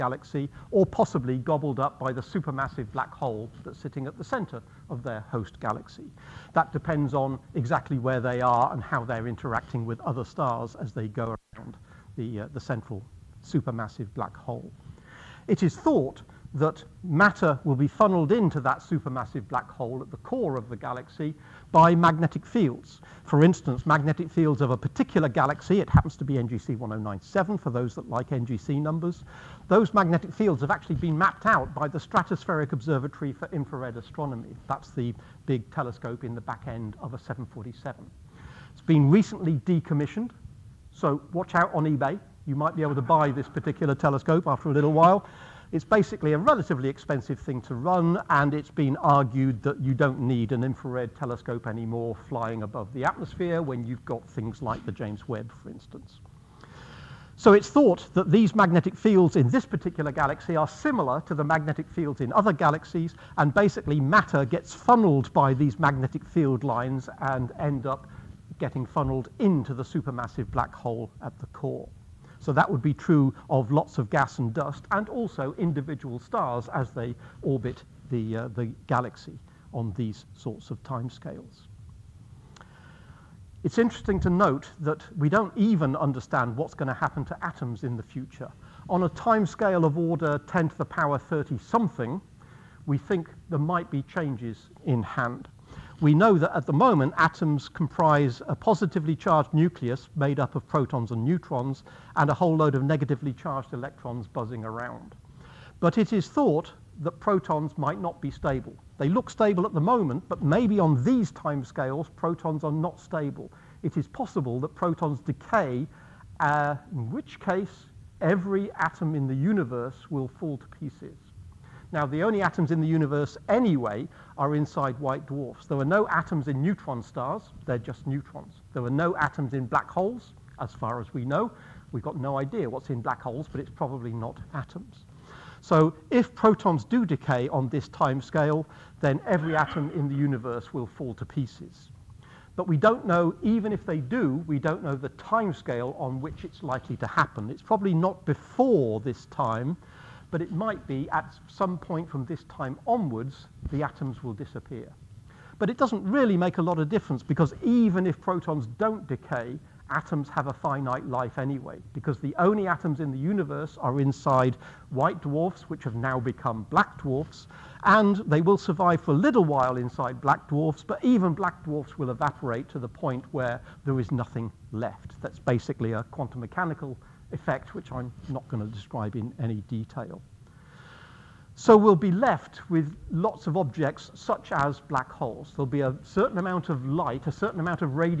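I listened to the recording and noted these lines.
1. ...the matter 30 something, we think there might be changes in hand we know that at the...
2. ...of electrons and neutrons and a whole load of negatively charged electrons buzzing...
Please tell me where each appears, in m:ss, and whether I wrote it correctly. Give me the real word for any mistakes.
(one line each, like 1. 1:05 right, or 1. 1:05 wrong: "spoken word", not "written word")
1. 1:30 wrong: "power", not "matter"
2. 1:40 wrong: "protons", not "electrons".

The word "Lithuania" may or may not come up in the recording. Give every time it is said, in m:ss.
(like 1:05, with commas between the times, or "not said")
not said.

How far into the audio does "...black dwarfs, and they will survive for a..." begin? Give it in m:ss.
2:46.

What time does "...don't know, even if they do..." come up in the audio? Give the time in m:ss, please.
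2:22.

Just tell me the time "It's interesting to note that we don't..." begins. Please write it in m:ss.
1:23.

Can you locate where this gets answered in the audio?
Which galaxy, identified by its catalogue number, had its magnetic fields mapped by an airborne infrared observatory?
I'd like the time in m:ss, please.
0:26.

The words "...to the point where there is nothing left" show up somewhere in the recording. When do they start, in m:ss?
2:52.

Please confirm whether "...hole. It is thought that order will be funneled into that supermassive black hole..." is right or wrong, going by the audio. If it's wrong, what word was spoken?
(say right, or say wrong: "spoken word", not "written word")
wrong: "matter", not "order".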